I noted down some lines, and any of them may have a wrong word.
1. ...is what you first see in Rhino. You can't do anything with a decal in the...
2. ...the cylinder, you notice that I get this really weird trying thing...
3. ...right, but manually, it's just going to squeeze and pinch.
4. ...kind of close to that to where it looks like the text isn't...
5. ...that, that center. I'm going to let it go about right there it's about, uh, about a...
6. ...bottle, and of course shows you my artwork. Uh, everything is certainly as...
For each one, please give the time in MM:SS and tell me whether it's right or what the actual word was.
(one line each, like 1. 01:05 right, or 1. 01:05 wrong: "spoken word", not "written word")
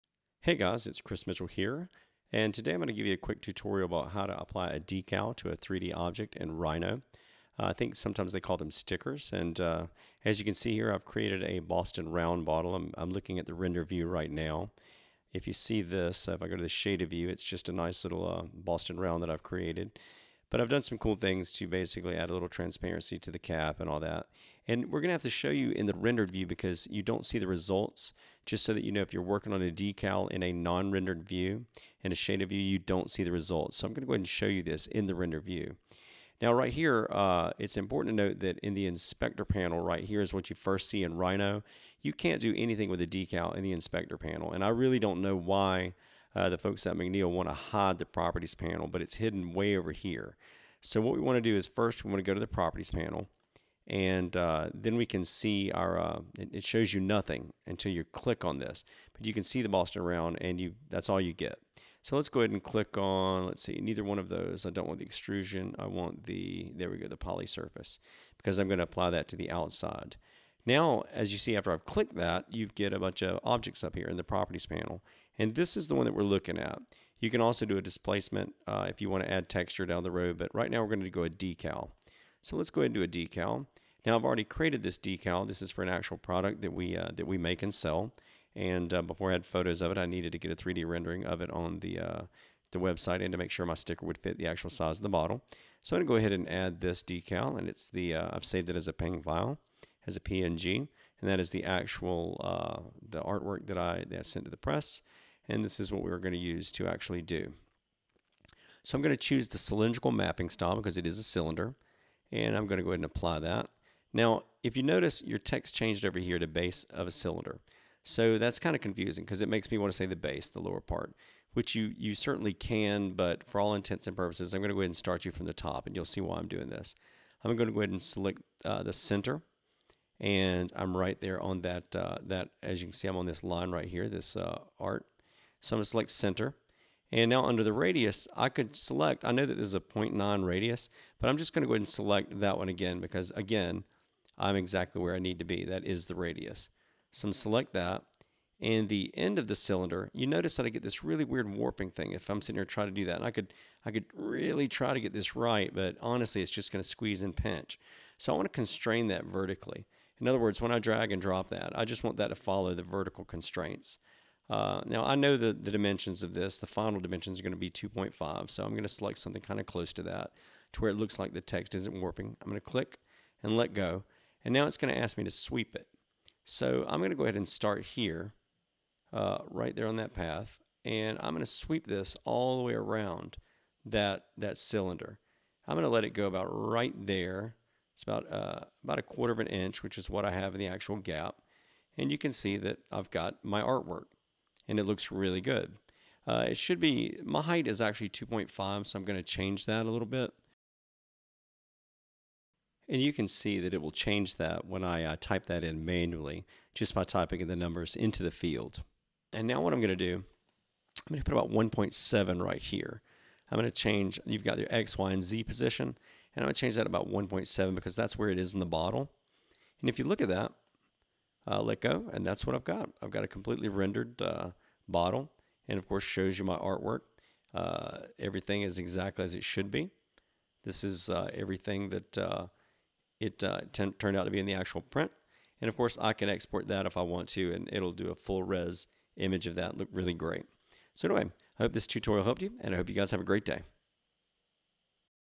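1. 00:40 right
2. 02:29 wrong: "warping", not "trying"
3. 02:35 wrong: "honestly", not "manually"
4. 02:49 right
5. 03:03 wrong: "cylinder", not "center"
6. 03:44 wrong: "exactly", not "certainly".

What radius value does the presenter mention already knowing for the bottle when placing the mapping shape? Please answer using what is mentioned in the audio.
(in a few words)
0.9.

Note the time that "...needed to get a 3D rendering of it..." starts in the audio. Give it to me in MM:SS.
01:30.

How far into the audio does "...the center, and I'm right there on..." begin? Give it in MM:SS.
02:08.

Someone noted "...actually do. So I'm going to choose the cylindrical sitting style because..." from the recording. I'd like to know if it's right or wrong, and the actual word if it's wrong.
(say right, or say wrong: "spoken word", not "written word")
wrong: "mapping", not "sitting".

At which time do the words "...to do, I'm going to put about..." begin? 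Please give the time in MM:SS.
03:29.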